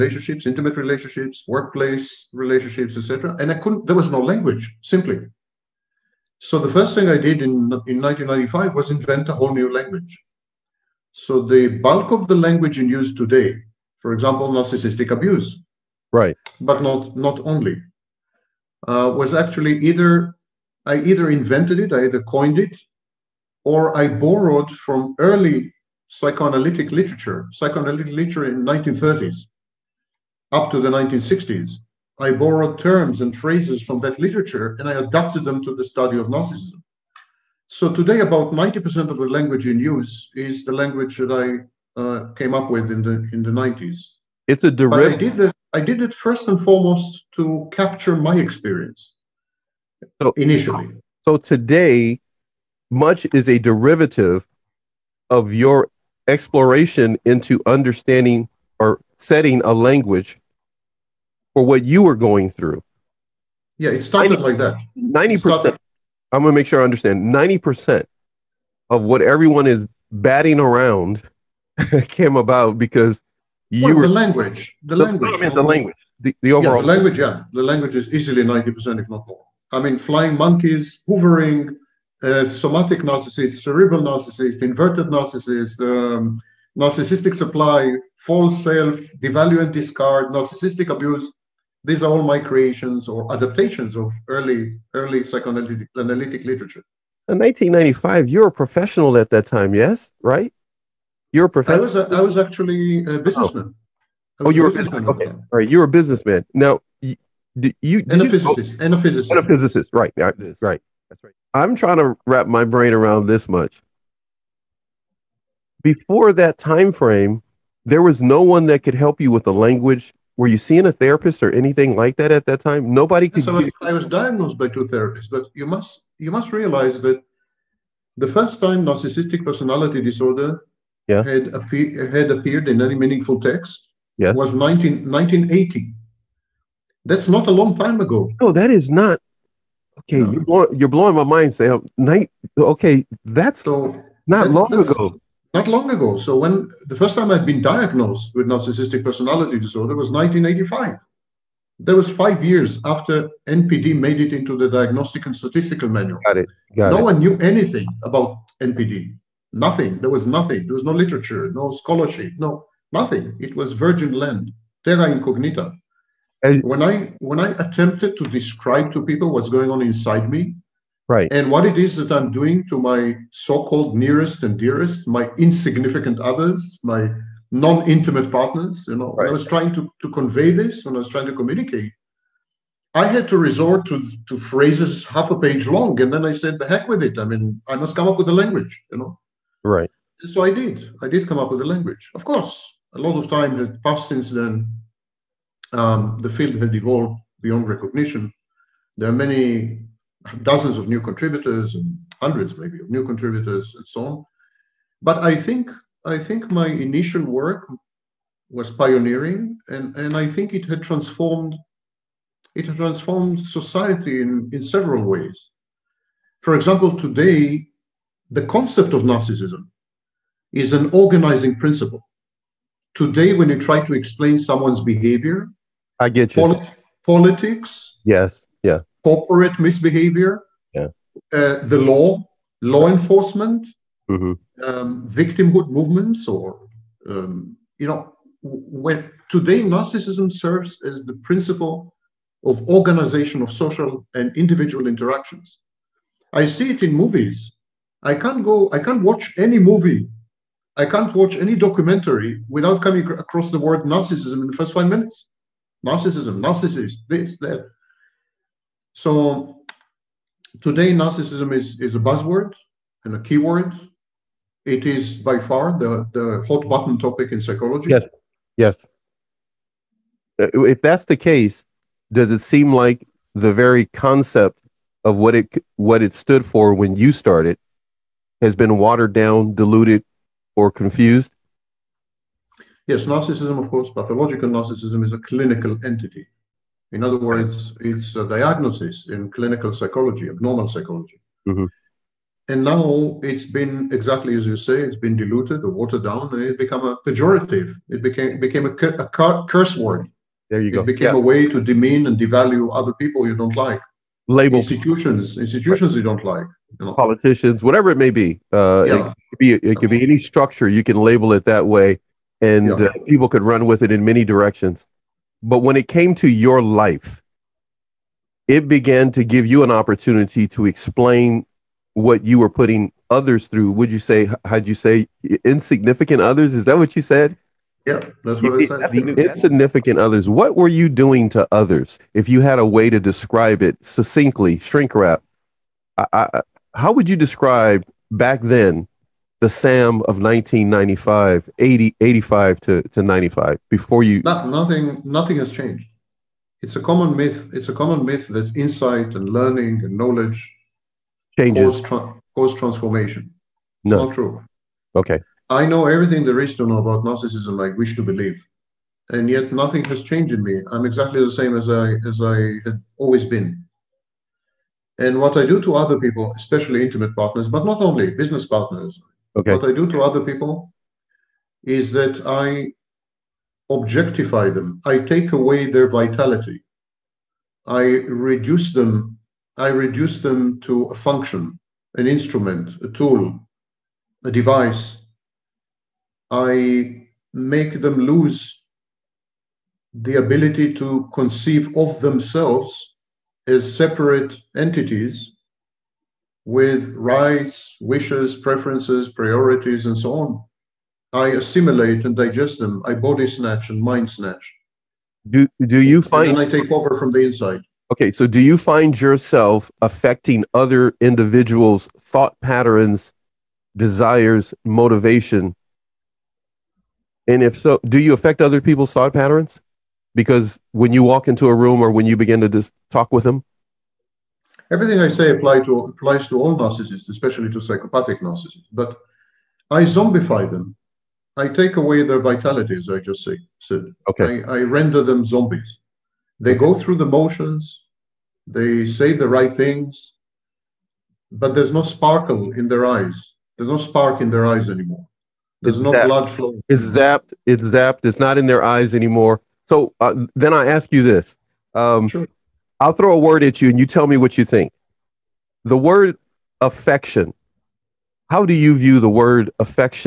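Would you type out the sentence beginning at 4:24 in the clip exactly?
It is by far the, the hot button topic in psychology.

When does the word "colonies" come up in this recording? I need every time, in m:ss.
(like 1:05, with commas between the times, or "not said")
not said.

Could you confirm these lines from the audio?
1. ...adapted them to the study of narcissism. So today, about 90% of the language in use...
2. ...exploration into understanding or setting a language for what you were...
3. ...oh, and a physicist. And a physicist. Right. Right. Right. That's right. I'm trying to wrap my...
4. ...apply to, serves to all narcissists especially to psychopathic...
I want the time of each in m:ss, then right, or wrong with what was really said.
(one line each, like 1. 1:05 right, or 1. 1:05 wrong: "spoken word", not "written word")
1. 0:34 right
2. 0:56 right
3. 1:48 right
4. 7:05 wrong: "applies", not "serves".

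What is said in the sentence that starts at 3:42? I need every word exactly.
Today, when you try to explain someone's behavior, I get you.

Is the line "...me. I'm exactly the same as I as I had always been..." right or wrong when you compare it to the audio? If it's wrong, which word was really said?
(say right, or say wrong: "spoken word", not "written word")
right.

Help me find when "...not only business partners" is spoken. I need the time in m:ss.
6:07.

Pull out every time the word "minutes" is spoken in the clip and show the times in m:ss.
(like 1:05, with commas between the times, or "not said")
4:14.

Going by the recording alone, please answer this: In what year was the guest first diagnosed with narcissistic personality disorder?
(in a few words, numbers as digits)
1985.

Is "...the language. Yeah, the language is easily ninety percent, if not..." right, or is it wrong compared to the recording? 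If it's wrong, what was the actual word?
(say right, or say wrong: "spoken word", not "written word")
right.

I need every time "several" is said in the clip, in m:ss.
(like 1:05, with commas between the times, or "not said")
3:34.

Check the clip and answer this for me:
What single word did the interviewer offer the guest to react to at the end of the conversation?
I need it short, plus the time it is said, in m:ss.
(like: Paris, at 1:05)
affection, at 7:36.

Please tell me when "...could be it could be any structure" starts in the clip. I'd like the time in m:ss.
5:09.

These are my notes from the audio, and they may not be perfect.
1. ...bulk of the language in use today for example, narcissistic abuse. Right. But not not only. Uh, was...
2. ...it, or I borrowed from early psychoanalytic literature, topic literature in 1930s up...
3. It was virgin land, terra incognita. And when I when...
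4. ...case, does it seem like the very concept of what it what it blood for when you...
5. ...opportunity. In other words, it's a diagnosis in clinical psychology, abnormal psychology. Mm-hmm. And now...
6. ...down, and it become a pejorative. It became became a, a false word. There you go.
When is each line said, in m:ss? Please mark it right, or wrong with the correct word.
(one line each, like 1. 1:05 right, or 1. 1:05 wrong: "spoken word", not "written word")
1. 0:11 right
2. 0:22 wrong: "psychoanalytic", not "topic"
3. 2:43 right
4. 4:31 wrong: "stood", not "blood"
5. 4:45 wrong: "entity", not "opportunity"
6. 4:56 wrong: "curse", not "false".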